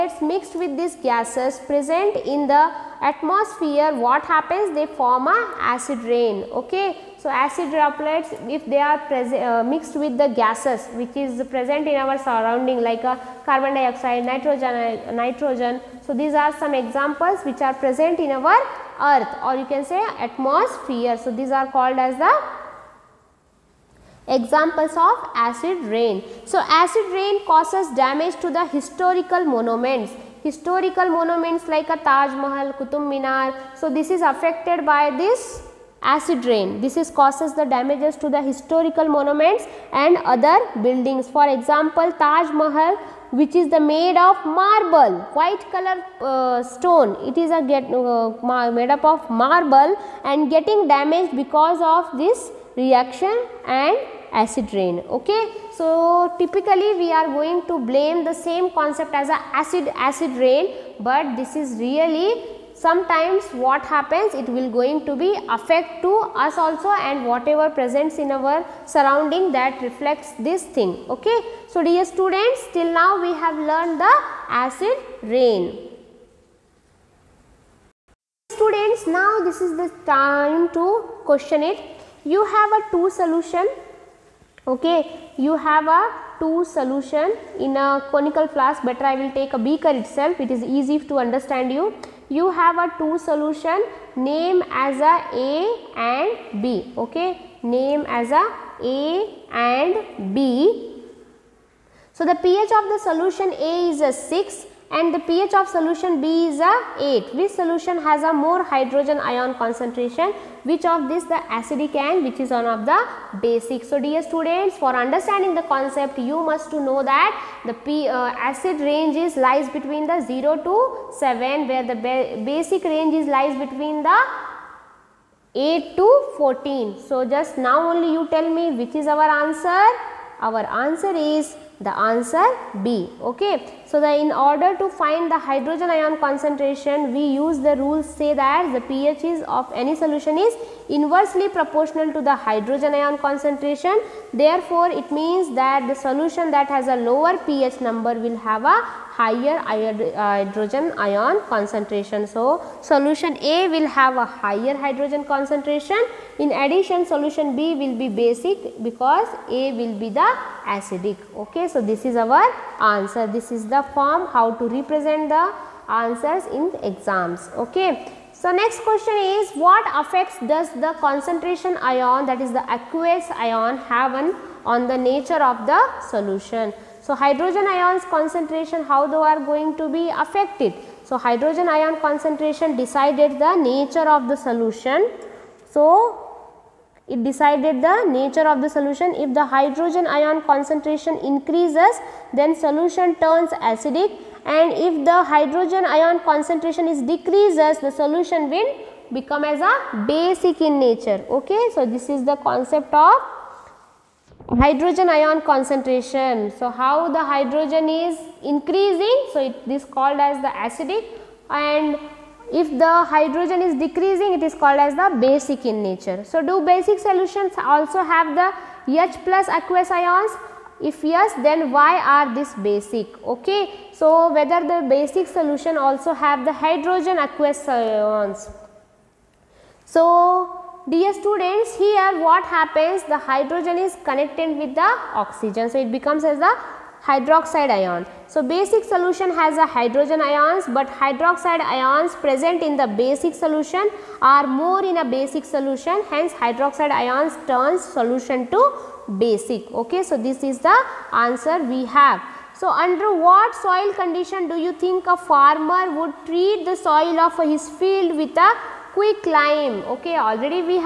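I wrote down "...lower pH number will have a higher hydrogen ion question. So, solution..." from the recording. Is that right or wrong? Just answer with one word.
wrong.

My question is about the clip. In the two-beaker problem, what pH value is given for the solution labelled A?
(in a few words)
6.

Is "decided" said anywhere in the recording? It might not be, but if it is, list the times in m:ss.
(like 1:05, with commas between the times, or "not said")
3:02, 3:07.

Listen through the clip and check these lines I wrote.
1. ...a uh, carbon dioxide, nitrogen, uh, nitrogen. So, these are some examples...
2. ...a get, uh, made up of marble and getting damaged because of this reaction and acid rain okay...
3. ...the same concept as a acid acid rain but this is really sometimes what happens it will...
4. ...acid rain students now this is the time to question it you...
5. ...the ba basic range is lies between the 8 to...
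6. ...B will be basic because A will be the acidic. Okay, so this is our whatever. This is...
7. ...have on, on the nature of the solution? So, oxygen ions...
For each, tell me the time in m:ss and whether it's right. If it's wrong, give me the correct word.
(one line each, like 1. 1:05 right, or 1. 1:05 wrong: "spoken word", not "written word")
1. 0:13 right
2. 0:47 right
3. 0:58 right
4. 1:14 right
5. 2:01 right
6. 2:37 wrong: "answer", not "whatever"
7. 2:53 wrong: "hydrogen", not "oxygen".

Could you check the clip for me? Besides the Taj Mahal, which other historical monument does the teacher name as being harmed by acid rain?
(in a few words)
Qutub Minar.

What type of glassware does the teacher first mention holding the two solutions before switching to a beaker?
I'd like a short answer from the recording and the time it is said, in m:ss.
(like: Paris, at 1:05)
Conical flask, at 1:28.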